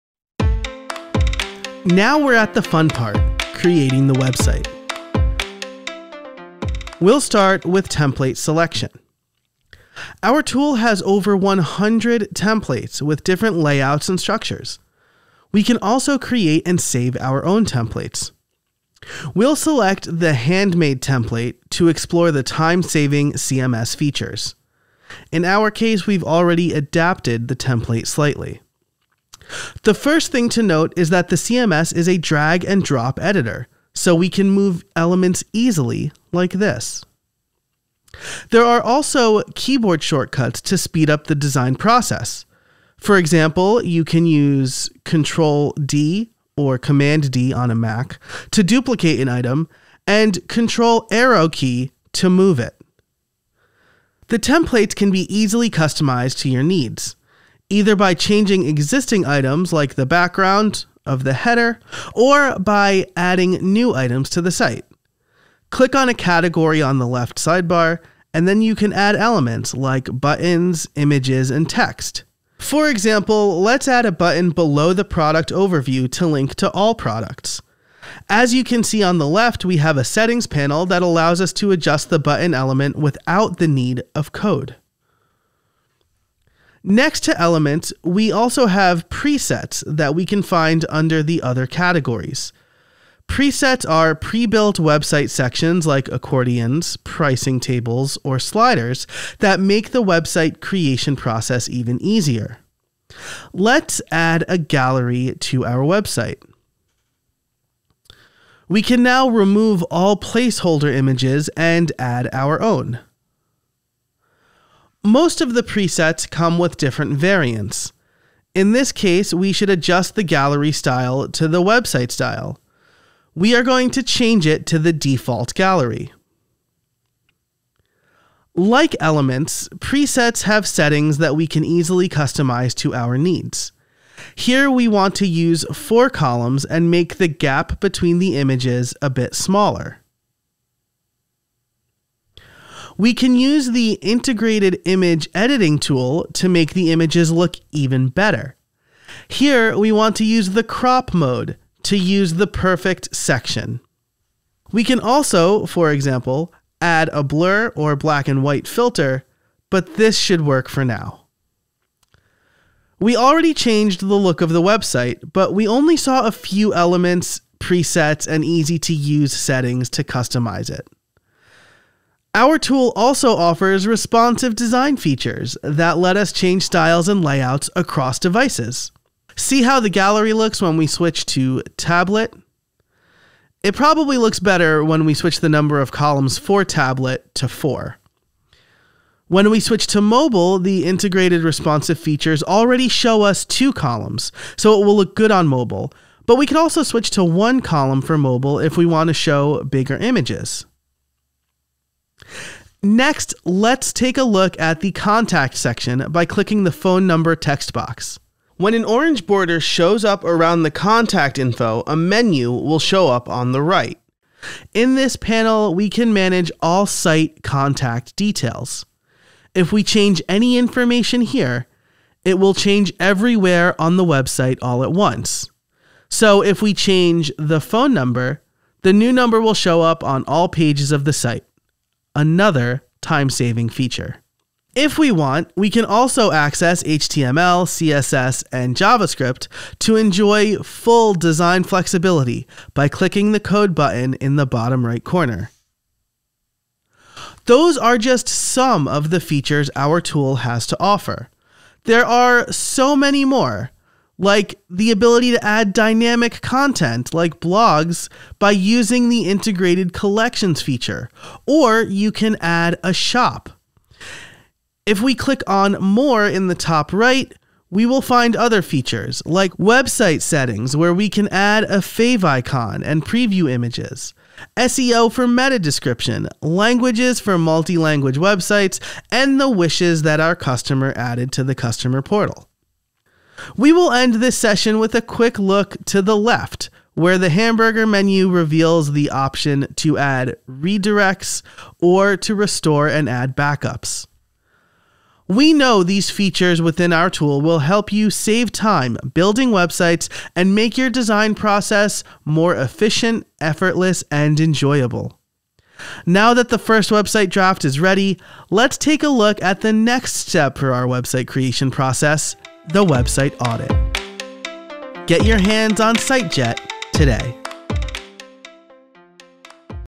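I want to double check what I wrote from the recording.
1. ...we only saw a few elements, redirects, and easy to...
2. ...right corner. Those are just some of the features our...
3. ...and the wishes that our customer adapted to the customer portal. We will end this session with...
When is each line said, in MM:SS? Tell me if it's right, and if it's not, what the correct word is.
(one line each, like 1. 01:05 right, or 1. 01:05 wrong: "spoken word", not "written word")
1. 02:45 wrong: "presets", not "redirects"
2. 04:04 right
3. 04:39 wrong: "added", not "adapted".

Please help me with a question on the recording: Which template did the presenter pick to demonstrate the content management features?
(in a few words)
handmade.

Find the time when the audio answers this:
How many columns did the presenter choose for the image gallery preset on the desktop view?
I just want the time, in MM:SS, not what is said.
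02:15.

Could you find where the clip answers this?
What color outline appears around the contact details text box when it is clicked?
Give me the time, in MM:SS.
03:28.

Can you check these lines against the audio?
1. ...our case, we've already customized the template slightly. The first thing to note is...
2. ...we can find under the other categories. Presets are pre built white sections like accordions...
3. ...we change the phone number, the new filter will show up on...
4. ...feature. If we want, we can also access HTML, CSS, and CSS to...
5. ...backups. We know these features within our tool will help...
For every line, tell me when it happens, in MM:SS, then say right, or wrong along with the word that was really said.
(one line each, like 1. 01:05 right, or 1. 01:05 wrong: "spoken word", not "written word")
1. 00:25 wrong: "adapted", not "customized"
2. 01:30 wrong: "website", not "white"
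3. 03:46 wrong: "number", not "filter"
4. 03:53 wrong: "JavaScript", not "CSS"
5. 04:53 right.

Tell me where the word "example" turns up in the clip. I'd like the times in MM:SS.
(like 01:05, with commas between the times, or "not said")
00:43, 01:12, 02:35.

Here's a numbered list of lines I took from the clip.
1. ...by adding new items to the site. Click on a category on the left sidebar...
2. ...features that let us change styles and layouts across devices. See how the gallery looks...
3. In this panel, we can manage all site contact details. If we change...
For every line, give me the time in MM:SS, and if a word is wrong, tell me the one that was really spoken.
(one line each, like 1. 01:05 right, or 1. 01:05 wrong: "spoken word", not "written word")
1. 01:02 right
2. 02:54 right
3. 03:34 right.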